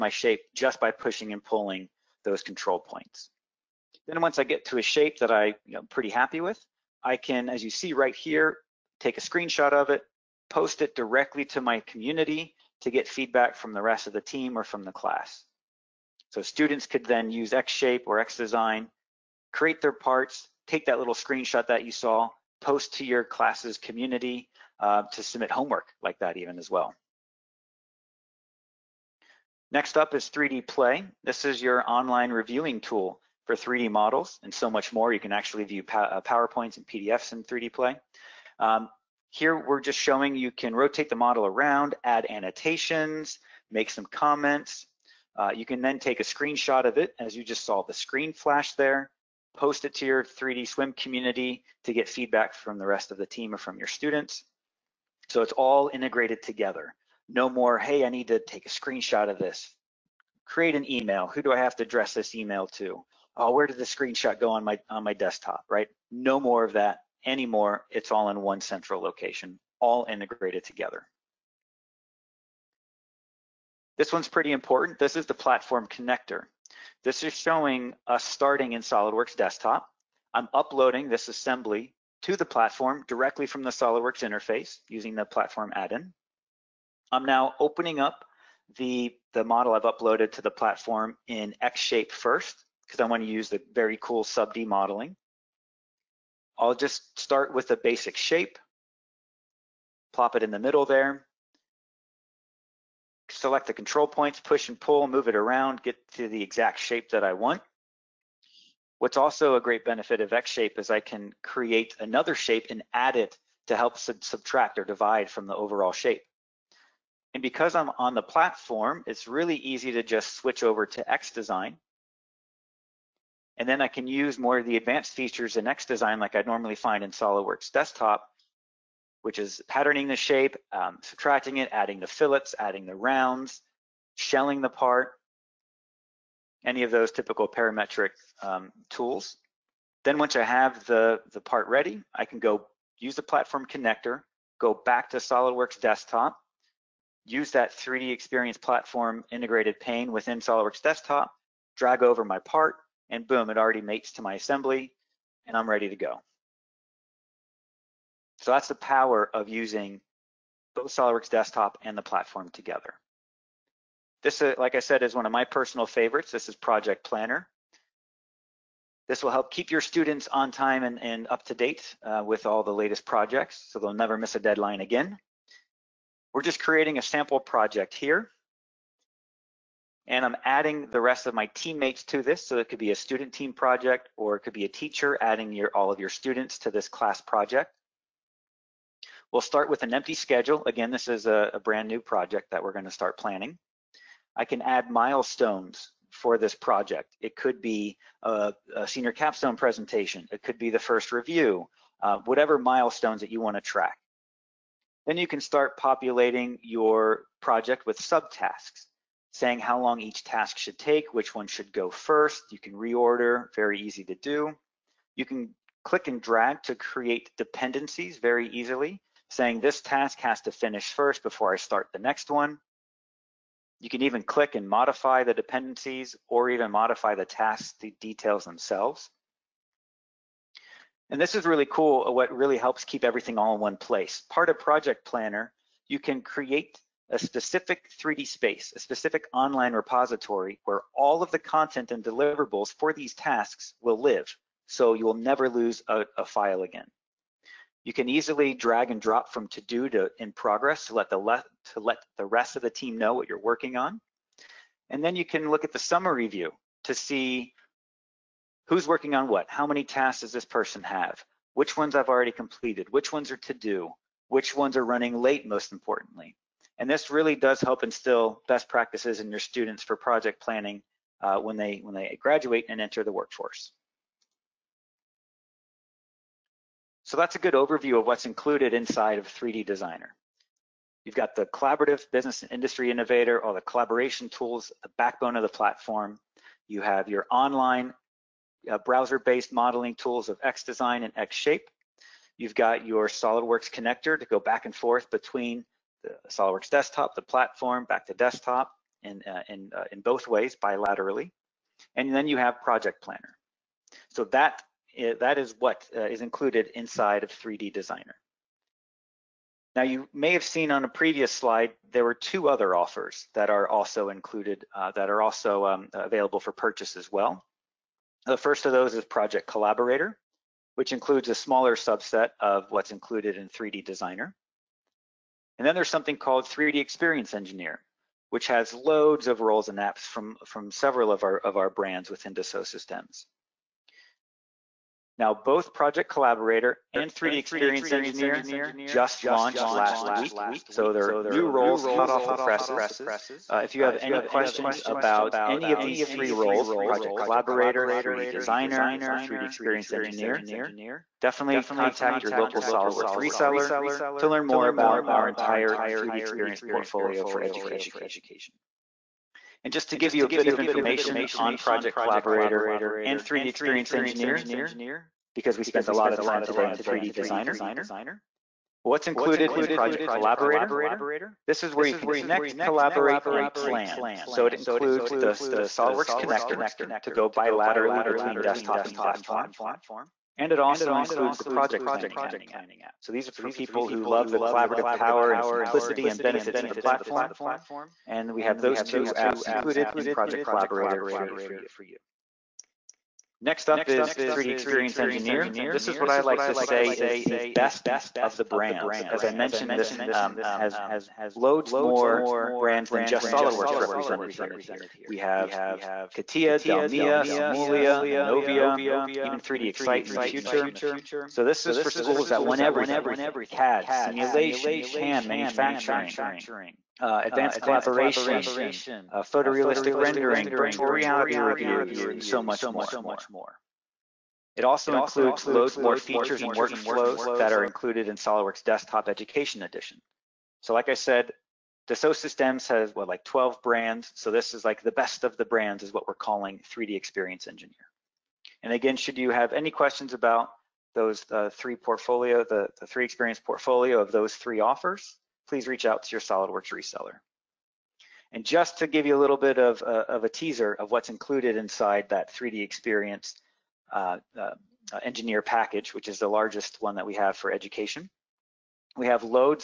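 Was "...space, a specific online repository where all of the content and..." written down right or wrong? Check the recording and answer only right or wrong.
right.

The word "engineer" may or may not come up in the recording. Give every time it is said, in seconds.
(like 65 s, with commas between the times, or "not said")
327 s, 337 s, 349 s, 363 s, 394 s, 437 s, 455 s.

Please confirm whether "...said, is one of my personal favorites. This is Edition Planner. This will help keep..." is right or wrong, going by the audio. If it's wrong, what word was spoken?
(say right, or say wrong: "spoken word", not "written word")
wrong: "Project", not "Edition".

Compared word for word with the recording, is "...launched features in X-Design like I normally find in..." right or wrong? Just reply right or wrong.
wrong.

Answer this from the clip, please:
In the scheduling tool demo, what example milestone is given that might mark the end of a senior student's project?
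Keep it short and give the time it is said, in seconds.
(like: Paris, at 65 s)
senior capstone presentation, at 198 s.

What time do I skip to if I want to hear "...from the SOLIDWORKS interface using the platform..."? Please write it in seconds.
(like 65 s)
83 s.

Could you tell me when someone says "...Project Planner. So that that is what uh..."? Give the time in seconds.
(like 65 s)
302 s.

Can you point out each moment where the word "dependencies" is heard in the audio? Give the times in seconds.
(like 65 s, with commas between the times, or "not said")
217 s, 225 s.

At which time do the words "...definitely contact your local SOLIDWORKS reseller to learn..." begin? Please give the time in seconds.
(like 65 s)
351 s.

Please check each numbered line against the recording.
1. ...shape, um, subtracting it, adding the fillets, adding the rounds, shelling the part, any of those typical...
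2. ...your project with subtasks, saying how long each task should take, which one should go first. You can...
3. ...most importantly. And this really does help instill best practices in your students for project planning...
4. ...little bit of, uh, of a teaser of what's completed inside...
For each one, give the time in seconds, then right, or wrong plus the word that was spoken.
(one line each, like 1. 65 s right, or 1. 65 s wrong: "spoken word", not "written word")
1. 130 s right
2. 206 s right
3. 265 s right
4. 449 s wrong: "included", not "completed".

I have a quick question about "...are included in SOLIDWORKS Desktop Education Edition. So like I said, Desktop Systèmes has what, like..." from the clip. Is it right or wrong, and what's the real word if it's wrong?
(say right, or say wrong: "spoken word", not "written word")
wrong: "Dassault", not "Desktop".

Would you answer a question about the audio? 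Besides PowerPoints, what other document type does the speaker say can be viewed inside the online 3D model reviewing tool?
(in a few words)
PDFs.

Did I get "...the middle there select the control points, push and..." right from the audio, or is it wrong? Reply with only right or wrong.
right.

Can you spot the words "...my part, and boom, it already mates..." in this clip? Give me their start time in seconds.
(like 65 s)
152 s.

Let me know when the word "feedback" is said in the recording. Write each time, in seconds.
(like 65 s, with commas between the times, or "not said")
13 s, 52 s.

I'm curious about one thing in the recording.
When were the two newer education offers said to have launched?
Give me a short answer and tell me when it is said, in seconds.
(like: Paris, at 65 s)
last week, at 339 s.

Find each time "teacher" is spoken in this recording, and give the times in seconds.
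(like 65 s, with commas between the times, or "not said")
184 s.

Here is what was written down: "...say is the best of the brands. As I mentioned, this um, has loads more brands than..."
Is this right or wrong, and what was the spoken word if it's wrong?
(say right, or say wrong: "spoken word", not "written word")
right.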